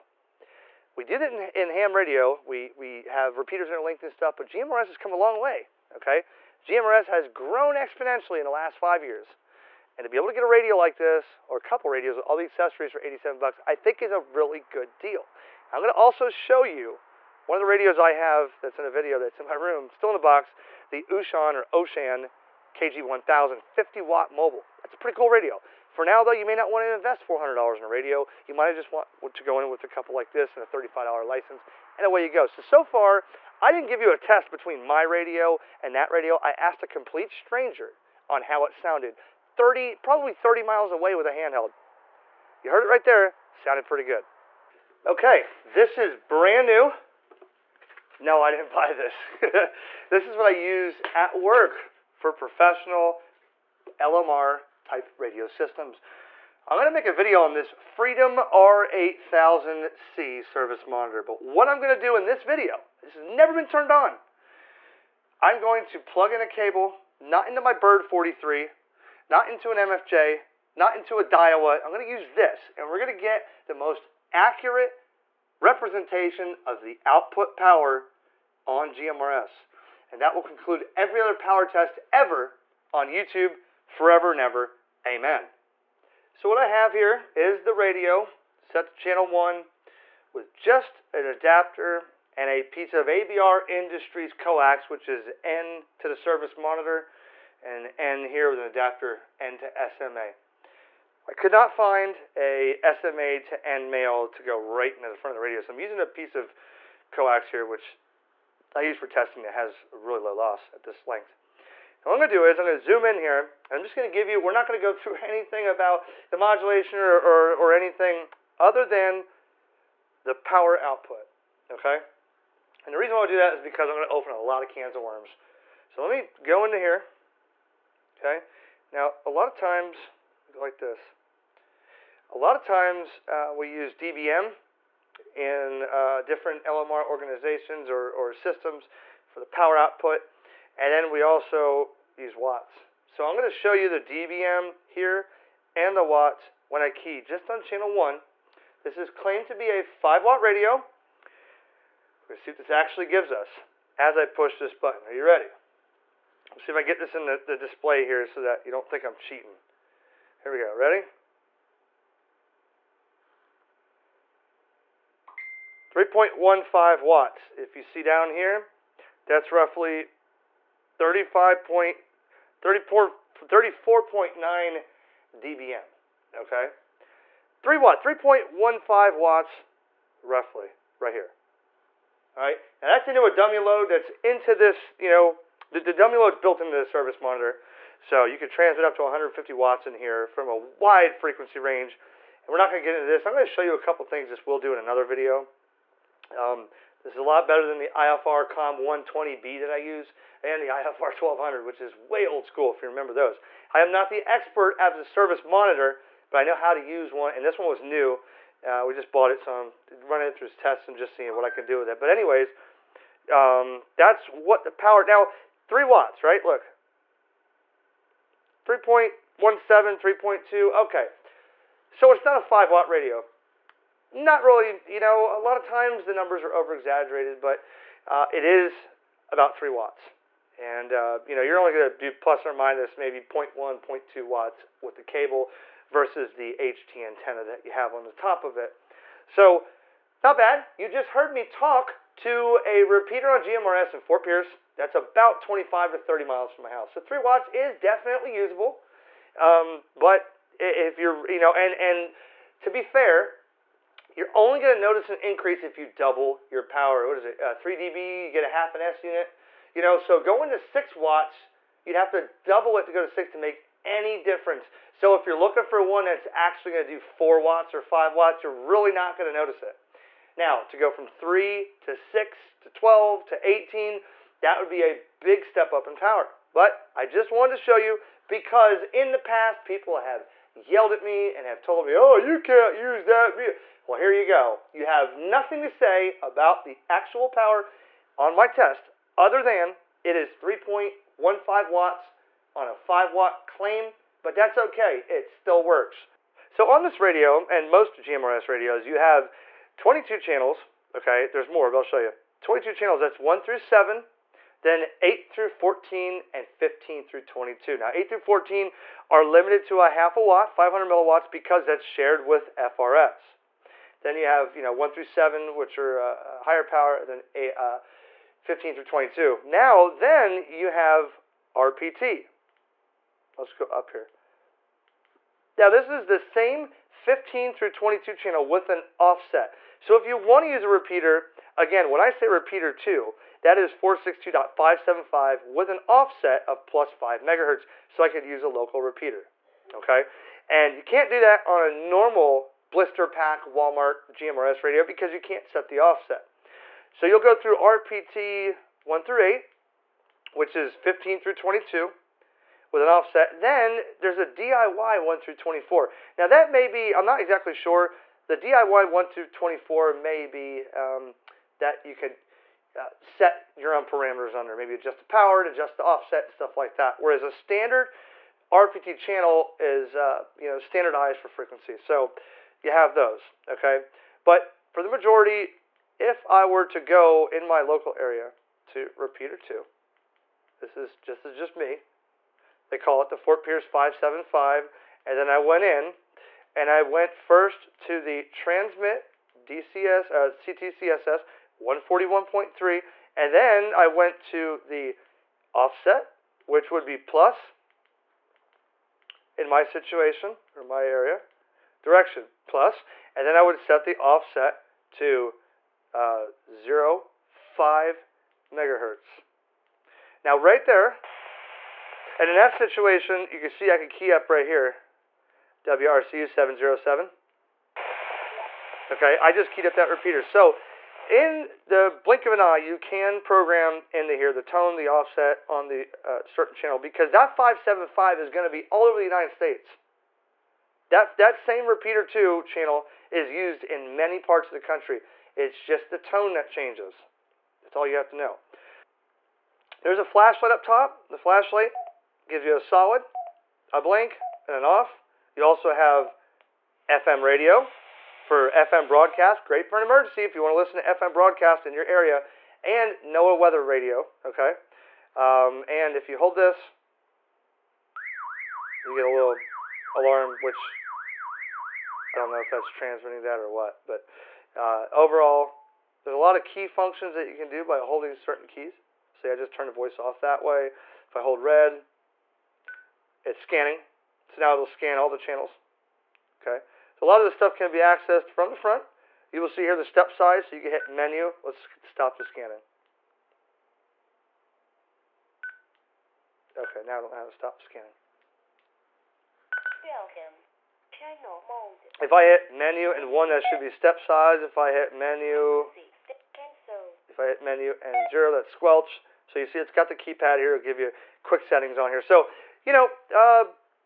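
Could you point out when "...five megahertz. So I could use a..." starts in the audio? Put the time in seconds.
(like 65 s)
336 s.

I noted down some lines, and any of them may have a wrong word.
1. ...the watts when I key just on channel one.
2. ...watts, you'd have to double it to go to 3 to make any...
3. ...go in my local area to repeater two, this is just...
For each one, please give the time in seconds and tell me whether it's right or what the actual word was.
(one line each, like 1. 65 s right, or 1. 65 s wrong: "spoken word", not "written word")
1. 145 s right
2. 260 s wrong: "6", not "3"
3. 376 s right.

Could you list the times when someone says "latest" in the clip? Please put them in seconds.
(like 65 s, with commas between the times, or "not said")
not said.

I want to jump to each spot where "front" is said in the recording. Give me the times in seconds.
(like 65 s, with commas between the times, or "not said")
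105 s, 478 s.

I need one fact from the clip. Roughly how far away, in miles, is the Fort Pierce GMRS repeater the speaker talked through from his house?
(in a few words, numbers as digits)
25 to 30 miles.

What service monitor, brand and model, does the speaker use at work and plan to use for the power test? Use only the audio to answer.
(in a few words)
Freedom R8000C.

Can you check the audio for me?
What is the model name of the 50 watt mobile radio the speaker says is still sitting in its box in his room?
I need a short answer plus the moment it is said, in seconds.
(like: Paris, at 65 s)
KG1000, at 22 s.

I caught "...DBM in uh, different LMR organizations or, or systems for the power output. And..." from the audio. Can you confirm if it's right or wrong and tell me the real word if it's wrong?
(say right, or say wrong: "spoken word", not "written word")
right.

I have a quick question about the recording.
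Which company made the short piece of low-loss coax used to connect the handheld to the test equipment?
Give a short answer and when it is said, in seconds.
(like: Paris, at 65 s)
ABR Industries, at 93 s.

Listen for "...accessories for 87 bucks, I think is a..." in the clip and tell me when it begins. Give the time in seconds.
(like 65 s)
12 s.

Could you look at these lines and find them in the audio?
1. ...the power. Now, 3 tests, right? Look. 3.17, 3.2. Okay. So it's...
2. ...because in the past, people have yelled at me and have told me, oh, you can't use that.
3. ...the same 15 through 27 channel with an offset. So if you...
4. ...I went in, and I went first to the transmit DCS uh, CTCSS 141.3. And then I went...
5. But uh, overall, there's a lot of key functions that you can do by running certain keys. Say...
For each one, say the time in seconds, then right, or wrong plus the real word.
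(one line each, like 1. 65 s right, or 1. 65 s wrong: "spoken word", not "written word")
1. 214 s wrong: "watts", not "tests"
2. 278 s right
3. 326 s wrong: "22", not "27"
4. 385 s right
5. 463 s wrong: "holding", not "running".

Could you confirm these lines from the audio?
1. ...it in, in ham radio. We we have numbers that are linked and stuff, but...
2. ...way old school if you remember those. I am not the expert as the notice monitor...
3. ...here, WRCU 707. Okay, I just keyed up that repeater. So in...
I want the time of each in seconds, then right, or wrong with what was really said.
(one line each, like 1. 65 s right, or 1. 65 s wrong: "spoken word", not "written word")
1. 1 s wrong: "repeaters", not "numbers"
2. 201 s wrong: "service", not "notice"
3. 414 s right.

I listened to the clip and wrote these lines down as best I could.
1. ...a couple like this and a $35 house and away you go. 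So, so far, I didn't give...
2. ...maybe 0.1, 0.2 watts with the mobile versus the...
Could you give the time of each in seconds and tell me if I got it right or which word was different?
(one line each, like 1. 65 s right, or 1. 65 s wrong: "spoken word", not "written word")
1. 29 s wrong: "license", not "house"
2. 232 s wrong: "cable", not "mobile".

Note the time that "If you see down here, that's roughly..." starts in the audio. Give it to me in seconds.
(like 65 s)
167 s.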